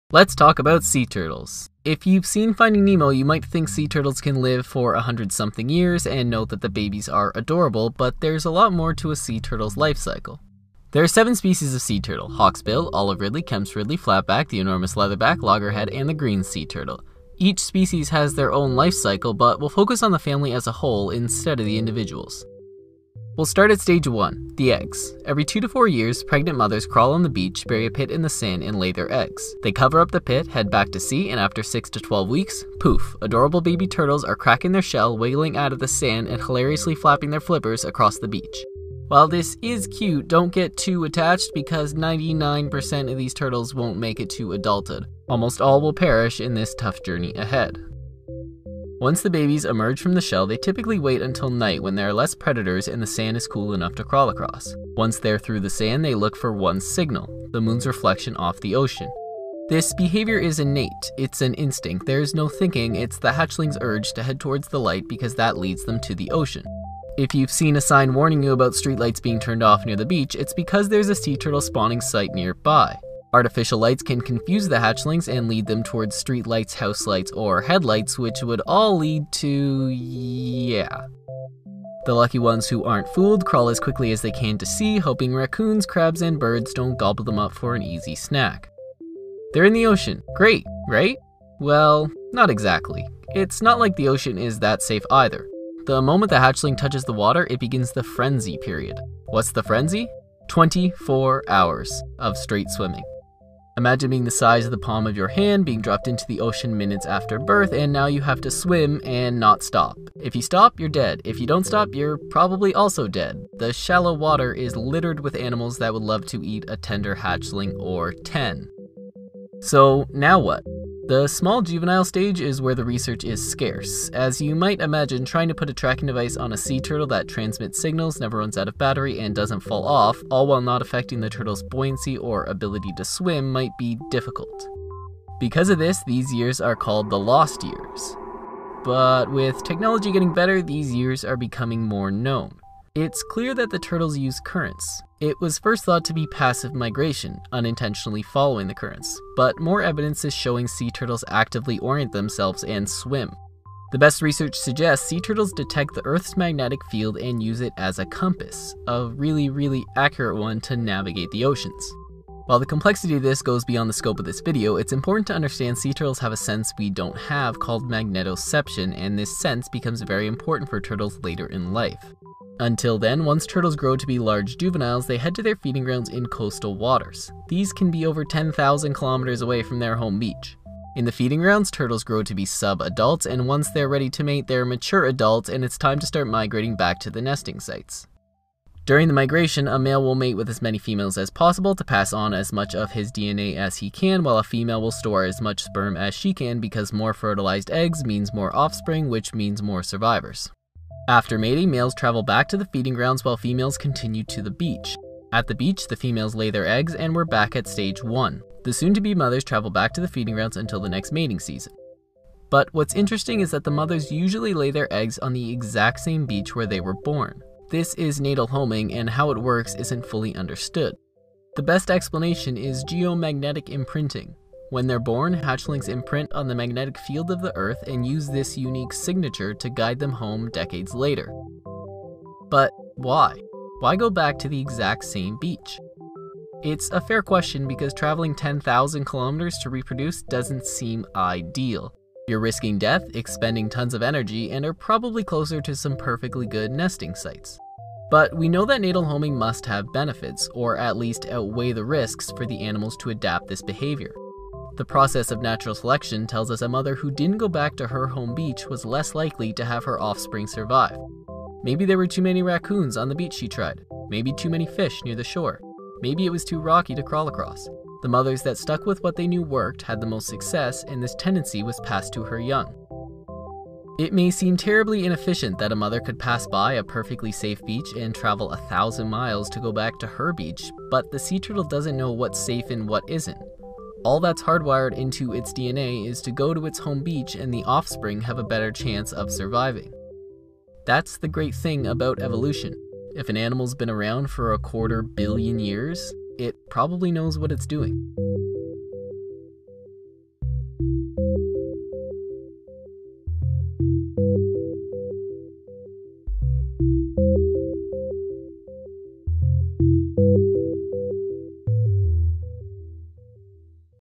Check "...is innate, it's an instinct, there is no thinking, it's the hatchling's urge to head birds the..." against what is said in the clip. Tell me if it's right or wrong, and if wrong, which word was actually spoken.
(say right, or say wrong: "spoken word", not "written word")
wrong: "towards", not "birds".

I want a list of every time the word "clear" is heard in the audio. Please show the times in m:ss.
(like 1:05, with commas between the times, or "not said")
2:23.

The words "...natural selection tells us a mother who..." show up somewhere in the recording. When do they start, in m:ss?
4:15.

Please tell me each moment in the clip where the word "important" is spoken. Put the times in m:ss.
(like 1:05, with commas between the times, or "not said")
2:44, 2:50.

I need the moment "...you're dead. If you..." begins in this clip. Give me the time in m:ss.
1:50.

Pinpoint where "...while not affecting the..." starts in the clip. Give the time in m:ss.
2:10.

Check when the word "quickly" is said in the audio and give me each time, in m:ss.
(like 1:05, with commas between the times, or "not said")
1:23.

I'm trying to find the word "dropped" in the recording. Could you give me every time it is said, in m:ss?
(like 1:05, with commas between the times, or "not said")
1:45.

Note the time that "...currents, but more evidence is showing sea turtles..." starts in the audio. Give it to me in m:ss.
2:28.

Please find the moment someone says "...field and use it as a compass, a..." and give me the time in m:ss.
2:36.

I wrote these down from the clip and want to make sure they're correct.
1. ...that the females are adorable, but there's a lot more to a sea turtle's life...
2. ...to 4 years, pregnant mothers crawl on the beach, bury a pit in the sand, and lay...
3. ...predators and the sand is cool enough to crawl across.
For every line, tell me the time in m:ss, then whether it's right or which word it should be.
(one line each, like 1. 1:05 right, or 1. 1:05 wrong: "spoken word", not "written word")
1. 0:06 wrong: "babies", not "females"
2. 0:25 right
3. 0:52 right.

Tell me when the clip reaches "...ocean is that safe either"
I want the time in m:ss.
1:34.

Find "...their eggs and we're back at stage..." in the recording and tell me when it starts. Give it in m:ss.
3:26.